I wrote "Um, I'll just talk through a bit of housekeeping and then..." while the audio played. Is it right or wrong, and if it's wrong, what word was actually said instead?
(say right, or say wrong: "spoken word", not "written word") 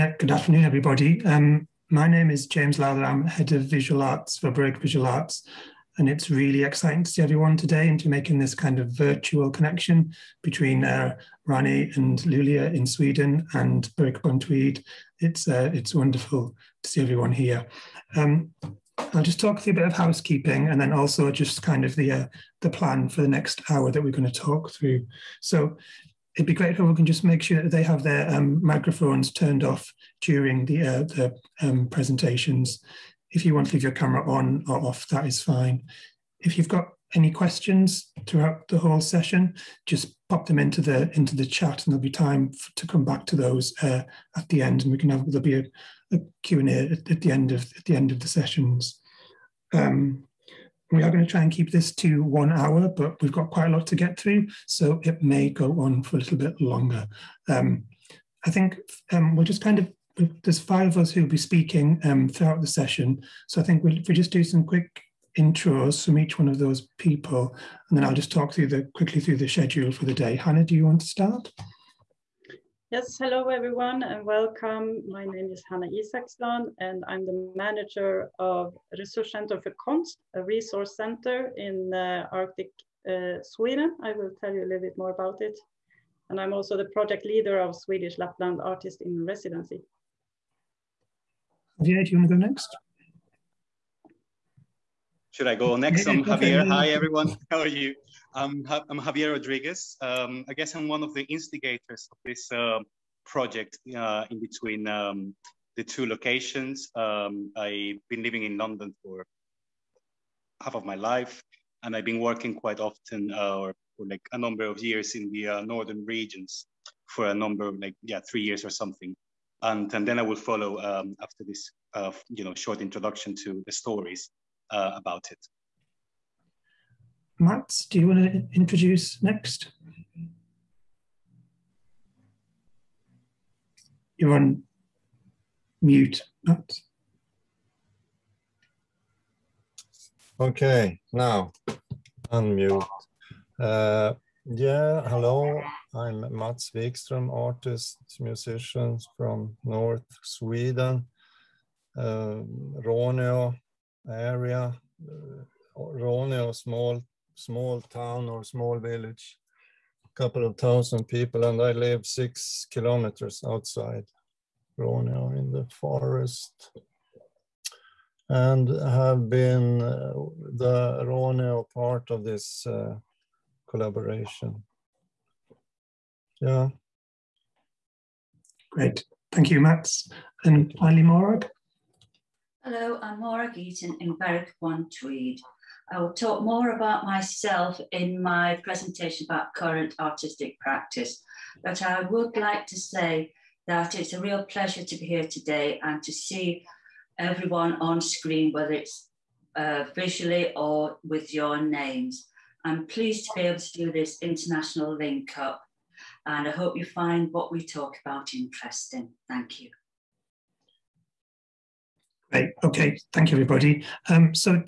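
right.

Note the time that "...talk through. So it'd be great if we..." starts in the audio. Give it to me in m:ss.
0:24.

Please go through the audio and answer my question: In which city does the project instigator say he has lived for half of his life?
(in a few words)
London.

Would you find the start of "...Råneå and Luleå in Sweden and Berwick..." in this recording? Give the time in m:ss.
0:11.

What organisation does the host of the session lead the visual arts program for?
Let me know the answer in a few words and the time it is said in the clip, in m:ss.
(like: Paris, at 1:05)
Berwick Visual Arts, at 0:04.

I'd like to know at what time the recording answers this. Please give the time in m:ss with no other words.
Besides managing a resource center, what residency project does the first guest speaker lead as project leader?
1:27.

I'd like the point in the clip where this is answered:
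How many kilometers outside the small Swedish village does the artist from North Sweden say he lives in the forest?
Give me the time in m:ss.
2:42.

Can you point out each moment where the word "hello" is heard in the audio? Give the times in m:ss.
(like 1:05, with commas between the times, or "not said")
1:13, 2:25, 3:02.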